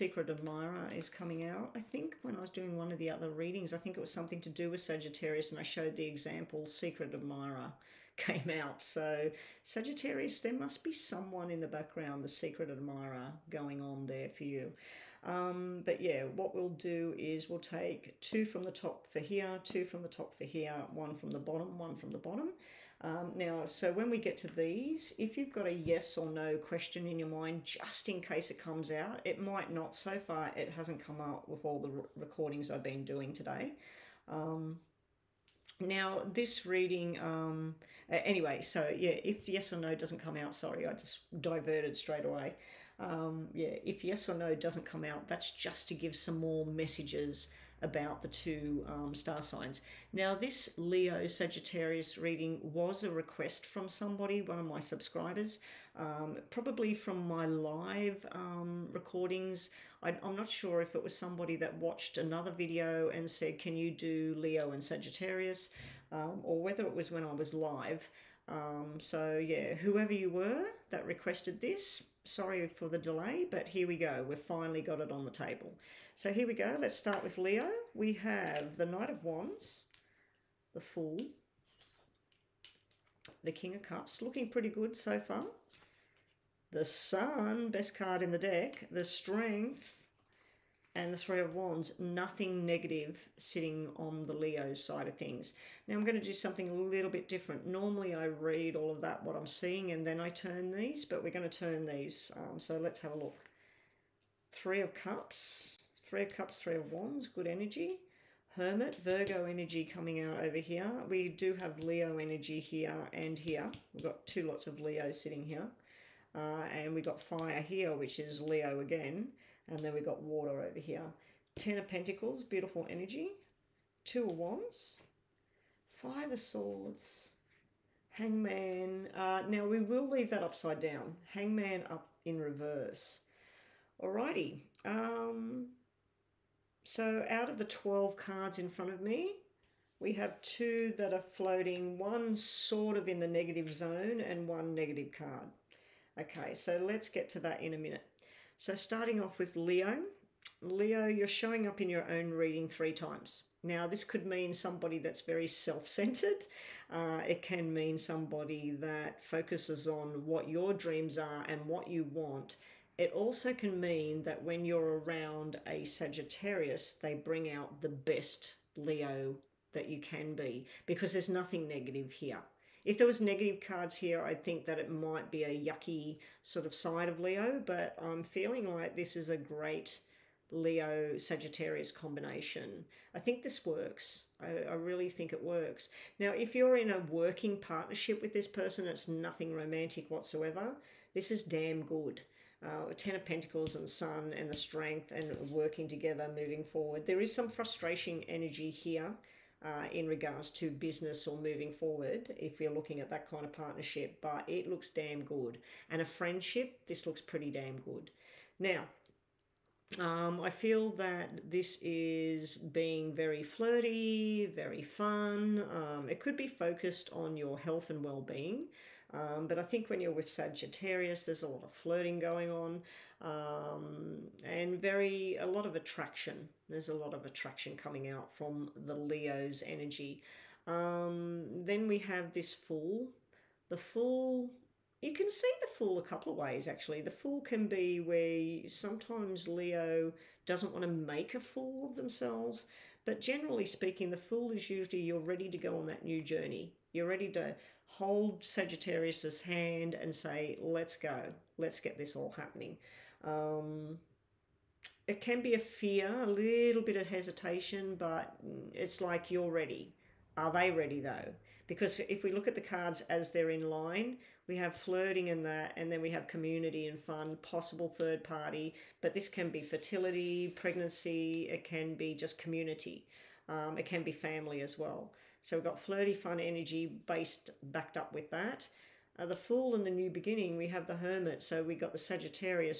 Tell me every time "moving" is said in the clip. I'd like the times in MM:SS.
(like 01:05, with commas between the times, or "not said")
03:16, 03:21.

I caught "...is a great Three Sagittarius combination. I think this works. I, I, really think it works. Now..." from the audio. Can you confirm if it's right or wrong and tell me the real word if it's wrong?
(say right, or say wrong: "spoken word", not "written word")
wrong: "Leo", not "Three".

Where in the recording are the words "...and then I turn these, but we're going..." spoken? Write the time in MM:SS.
01:39.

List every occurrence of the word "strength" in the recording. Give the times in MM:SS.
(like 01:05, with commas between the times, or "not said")
01:29, 03:14.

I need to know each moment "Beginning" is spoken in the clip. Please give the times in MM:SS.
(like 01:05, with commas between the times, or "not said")
04:40.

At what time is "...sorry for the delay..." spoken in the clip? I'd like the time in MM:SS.
01:12.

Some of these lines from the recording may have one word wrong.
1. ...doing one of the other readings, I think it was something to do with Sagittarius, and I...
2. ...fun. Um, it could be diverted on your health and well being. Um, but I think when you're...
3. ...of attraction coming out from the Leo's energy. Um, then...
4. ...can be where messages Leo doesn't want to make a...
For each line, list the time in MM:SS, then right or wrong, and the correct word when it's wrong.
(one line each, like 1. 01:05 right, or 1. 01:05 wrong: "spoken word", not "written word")
1. 00:02 right
2. 03:34 wrong: "focused", not "diverted"
3. 03:47 right
4. 03:57 wrong: "sometimes", not "messages".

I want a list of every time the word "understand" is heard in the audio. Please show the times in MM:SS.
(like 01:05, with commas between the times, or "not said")
not said.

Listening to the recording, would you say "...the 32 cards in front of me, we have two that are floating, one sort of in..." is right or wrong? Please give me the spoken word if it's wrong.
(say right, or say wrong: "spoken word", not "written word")
wrong: "12", not "32".